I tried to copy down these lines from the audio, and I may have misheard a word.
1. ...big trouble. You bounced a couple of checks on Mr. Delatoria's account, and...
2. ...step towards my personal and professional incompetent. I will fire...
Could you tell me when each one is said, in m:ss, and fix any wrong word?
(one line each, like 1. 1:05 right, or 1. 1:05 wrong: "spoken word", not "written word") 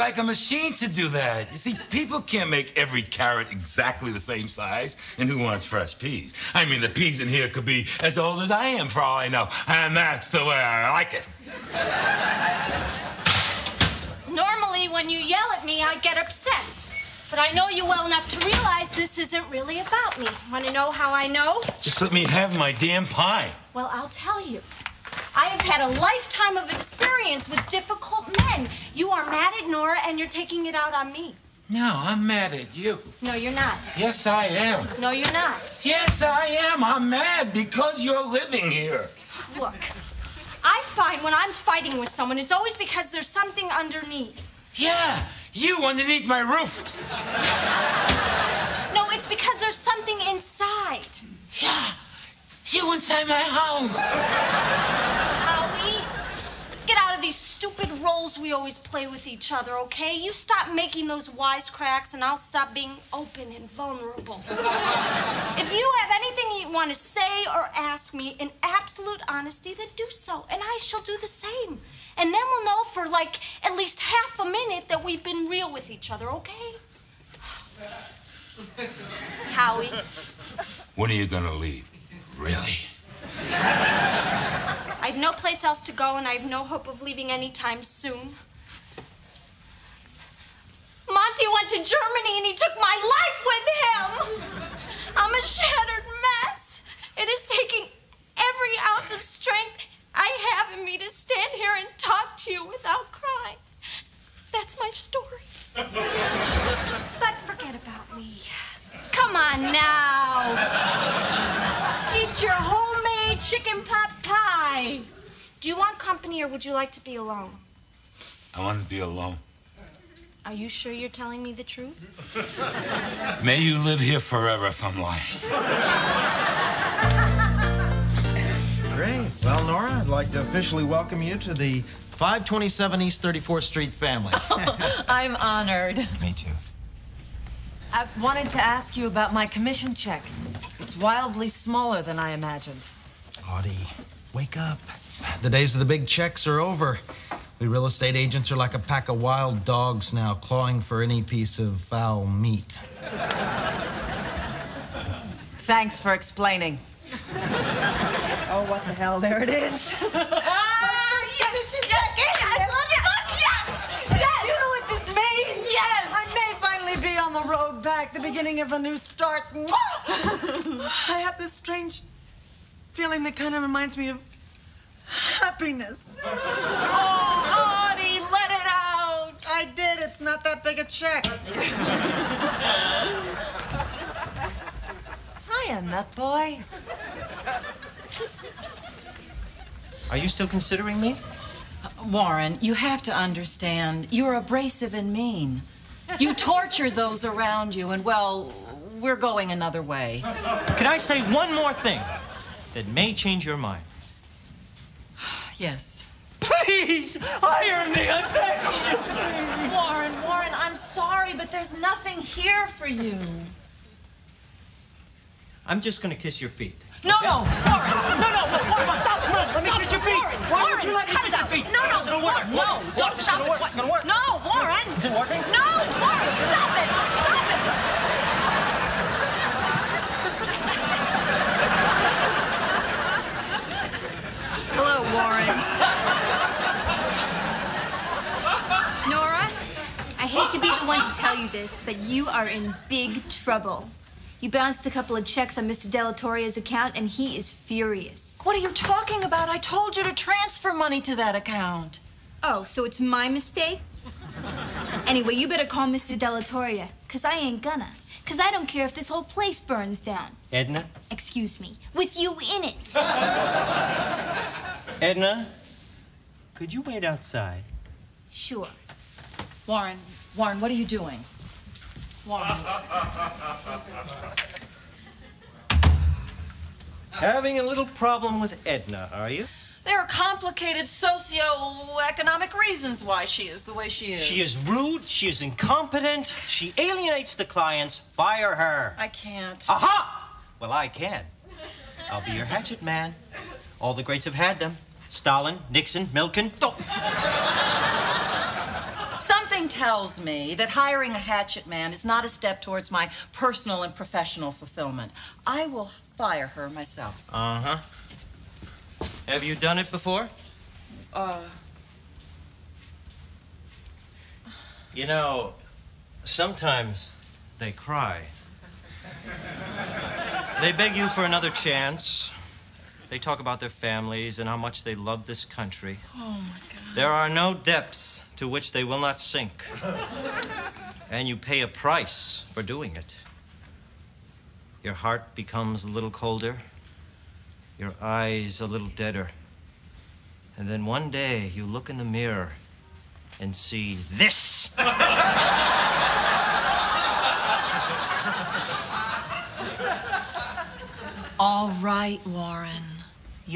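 1. 4:02 right
2. 5:02 wrong: "fulfillment", not "incompetent".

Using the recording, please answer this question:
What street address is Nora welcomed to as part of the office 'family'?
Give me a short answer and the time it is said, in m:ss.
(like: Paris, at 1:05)
527 East 34th Street, at 2:11.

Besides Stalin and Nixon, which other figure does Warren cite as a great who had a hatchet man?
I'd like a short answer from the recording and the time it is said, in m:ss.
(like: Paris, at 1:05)
Milken, at 4:56.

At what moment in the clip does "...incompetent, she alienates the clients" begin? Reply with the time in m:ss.
4:45.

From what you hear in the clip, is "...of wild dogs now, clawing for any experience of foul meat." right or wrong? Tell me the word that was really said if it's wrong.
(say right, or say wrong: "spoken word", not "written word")
wrong: "piece", not "experience".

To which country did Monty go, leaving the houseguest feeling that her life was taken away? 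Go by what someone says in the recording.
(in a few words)
Germany.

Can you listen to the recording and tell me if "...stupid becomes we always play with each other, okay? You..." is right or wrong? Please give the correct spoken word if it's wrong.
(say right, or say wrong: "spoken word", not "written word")
wrong: "roles", not "becomes".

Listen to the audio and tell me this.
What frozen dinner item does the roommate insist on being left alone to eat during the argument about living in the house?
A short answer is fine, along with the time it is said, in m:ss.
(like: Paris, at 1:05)
Chicken pot pie, at 1:53.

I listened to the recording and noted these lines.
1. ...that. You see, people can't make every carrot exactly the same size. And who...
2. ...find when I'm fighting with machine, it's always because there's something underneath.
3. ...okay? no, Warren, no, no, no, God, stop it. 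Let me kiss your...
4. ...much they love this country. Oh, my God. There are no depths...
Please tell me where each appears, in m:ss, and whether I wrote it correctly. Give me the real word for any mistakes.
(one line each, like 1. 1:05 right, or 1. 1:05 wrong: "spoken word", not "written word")
1. 0:01 right
2. 0:40 wrong: "someone", not "machine"
3. 3:37 wrong: "Warren", not "God"
4. 5:24 right.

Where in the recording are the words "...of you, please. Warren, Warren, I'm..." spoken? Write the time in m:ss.
3:28.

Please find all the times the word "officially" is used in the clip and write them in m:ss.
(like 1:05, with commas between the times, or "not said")
2:10.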